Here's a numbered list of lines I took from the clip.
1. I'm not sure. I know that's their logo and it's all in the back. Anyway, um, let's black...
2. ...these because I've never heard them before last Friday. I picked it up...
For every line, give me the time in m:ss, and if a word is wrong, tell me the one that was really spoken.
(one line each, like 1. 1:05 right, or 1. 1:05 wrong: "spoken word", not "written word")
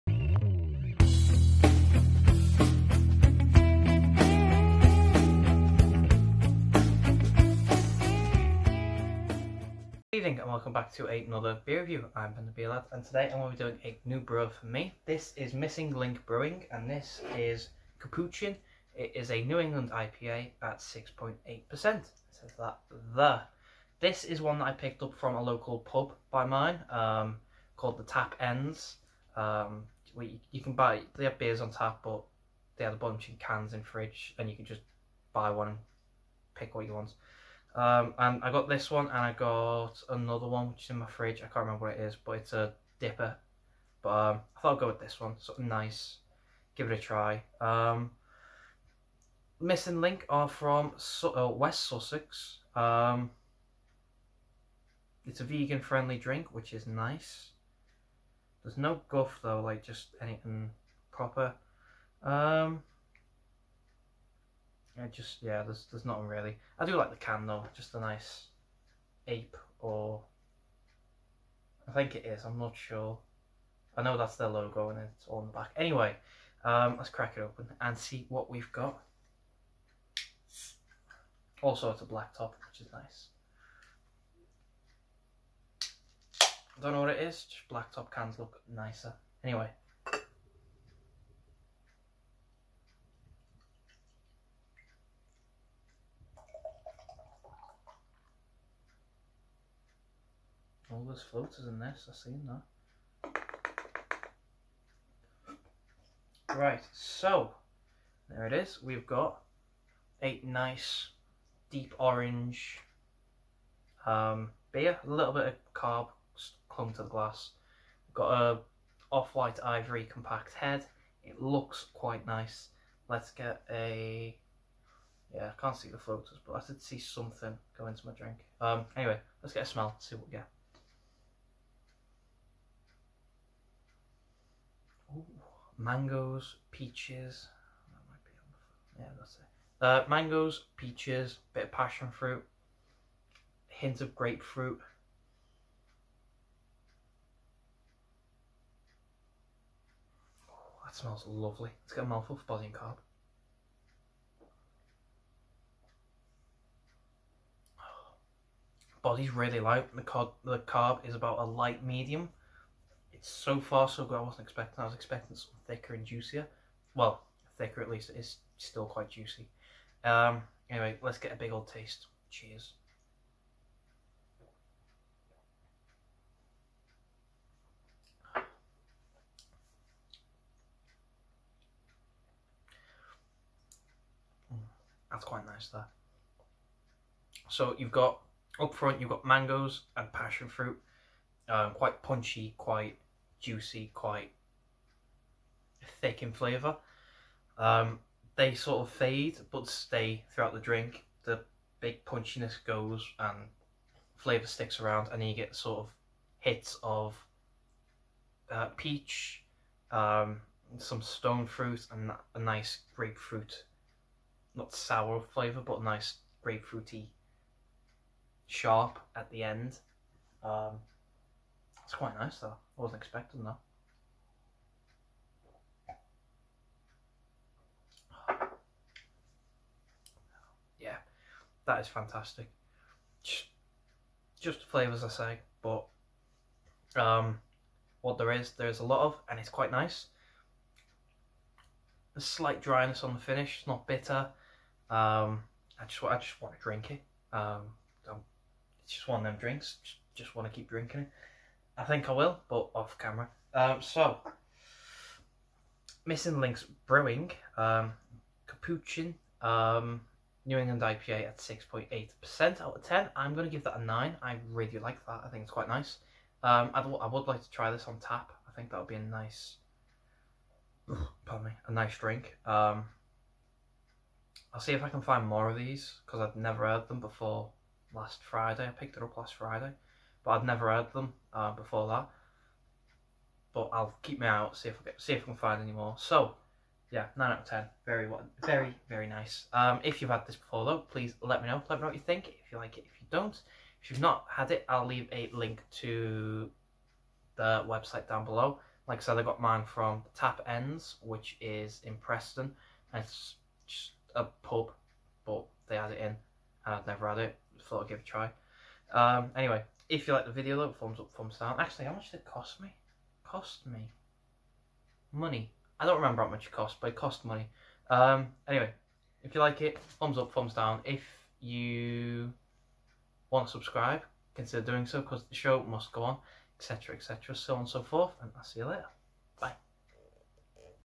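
1. 1:12 wrong: "crack", not "black"
2. 4:35 right.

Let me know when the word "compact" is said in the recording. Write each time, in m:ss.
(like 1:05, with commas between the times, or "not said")
2:00.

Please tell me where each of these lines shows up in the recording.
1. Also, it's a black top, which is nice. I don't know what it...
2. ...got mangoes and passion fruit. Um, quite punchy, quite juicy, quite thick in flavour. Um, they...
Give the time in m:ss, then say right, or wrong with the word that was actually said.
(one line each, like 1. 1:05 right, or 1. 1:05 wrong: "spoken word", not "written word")
1. 1:21 right
2. 3:09 right.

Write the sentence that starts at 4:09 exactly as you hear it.
Just, just want to keep drinking it.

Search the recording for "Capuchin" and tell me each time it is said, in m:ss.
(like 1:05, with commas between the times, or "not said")
0:17, 4:18.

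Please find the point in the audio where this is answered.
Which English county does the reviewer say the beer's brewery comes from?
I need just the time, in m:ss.
0:51.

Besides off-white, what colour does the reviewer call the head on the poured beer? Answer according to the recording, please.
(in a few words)
ivory.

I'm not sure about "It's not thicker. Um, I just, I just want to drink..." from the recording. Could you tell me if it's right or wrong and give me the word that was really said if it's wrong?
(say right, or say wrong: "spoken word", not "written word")
wrong: "bitter", not "thicker".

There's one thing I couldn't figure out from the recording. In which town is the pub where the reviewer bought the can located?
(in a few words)
Preston.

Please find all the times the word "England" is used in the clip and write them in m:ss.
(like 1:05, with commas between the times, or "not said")
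0:19, 4:20.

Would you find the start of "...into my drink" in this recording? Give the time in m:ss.
2:07.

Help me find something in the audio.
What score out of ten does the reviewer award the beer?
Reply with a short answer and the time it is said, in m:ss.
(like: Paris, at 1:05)
9, at 4:23.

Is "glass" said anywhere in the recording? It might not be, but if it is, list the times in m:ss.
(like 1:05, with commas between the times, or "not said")
1:57.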